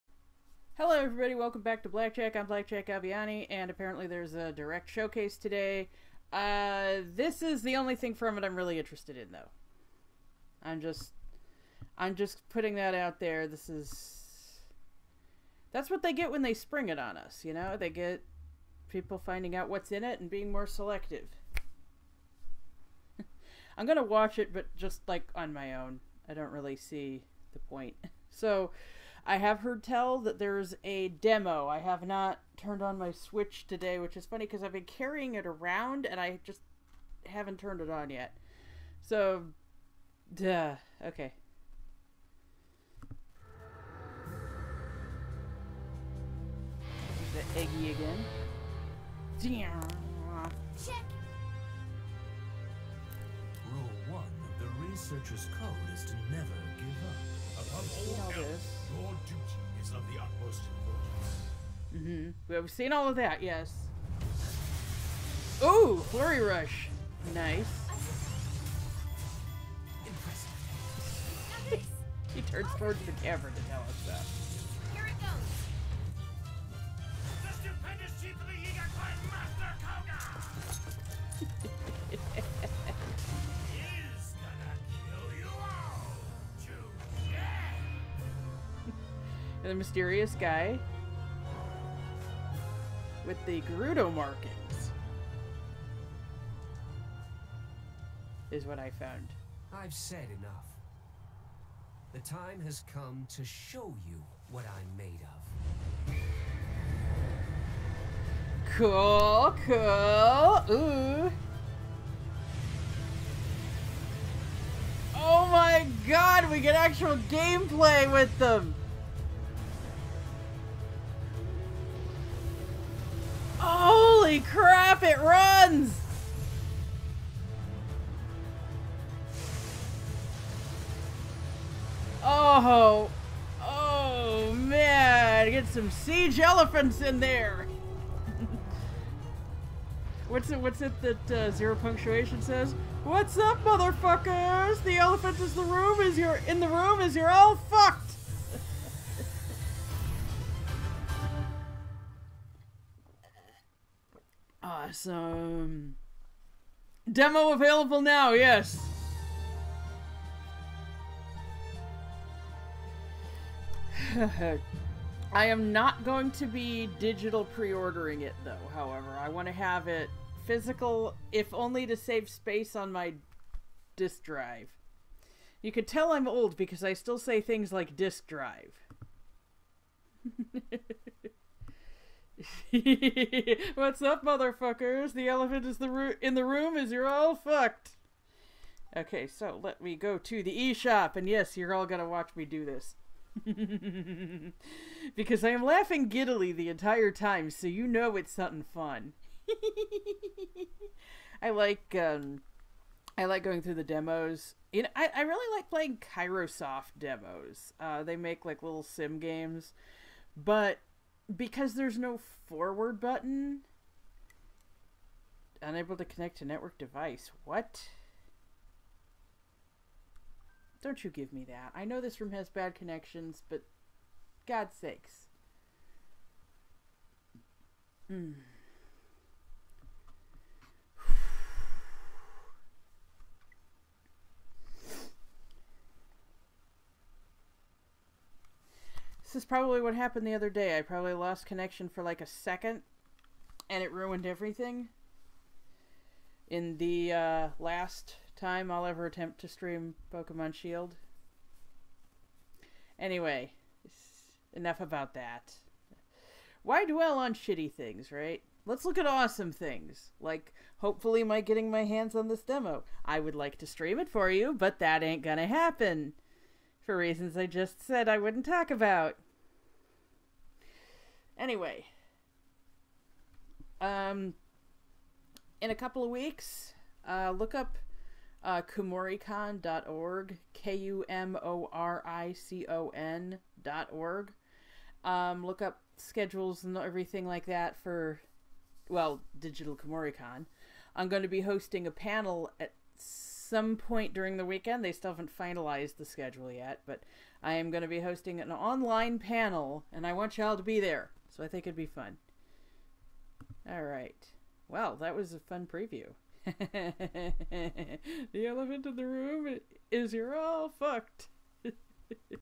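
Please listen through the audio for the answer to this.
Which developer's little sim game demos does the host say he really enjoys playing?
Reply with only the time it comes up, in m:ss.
3:26.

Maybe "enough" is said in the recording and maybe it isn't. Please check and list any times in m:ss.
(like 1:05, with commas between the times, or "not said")
1:40, 4:14.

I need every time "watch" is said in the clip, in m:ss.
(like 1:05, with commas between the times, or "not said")
0:24, 3:12.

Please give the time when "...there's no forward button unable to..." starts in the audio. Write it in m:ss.
3:31.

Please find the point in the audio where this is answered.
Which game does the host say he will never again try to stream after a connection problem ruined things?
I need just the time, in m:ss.
4:10.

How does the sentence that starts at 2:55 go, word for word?
You could tell I'm old because I still say things like disk drive.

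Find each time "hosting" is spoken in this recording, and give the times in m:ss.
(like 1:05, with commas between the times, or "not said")
4:51, 4:58.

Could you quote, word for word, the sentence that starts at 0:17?
They get people finding out what's in it and being more selective.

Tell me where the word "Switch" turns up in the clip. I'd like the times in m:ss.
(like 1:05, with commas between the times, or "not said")
0:33.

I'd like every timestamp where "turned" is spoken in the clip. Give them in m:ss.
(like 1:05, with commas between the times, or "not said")
0:32, 0:37.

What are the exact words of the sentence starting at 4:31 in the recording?
Anyway, um, in a couple of weeks, uh, look up uh, kumoricon.org, K U M O R I C O N.org.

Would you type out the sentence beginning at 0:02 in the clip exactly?
I'm Blackjack Aviani, and apparently there's a direct showcase today.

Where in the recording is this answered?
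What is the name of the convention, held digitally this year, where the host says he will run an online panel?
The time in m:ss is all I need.
4:49.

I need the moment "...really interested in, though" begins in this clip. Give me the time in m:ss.
0:08.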